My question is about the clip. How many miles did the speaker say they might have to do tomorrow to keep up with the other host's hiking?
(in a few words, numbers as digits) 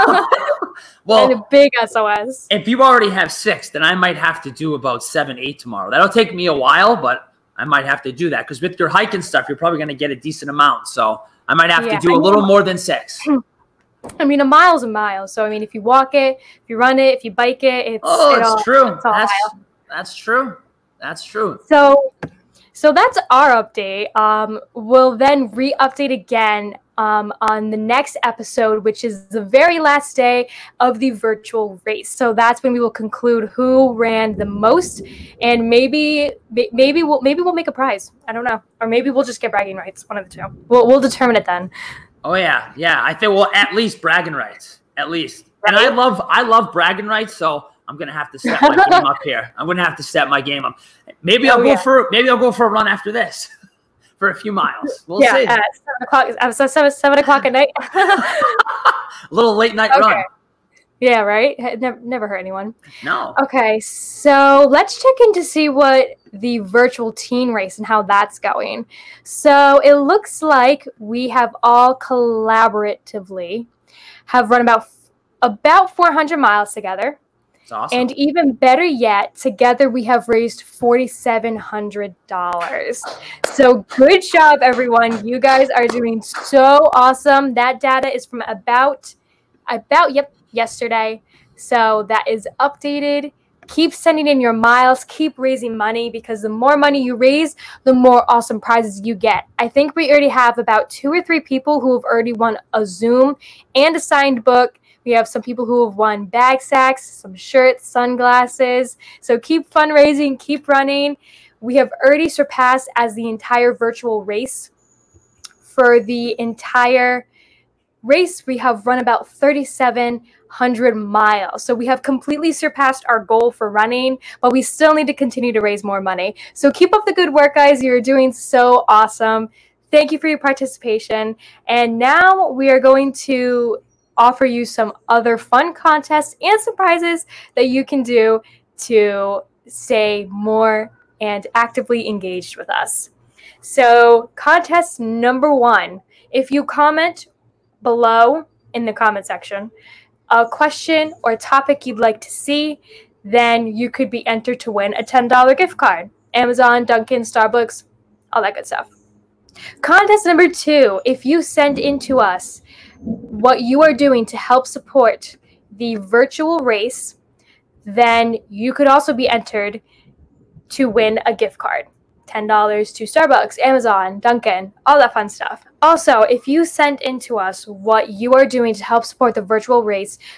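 7 or 8.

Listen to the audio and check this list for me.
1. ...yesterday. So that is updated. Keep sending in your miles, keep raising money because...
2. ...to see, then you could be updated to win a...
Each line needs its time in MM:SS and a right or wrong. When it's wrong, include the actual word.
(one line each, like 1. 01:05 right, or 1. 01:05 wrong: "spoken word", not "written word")
1. 01:30 right
2. 02:32 wrong: "entered", not "updated".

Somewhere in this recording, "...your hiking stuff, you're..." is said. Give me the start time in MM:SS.
00:08.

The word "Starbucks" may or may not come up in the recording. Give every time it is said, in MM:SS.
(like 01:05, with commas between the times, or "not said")
02:37, 02:53.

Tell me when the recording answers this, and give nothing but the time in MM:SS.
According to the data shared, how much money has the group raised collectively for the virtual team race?
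01:20.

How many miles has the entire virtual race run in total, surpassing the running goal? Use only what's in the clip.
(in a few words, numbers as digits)
3,700.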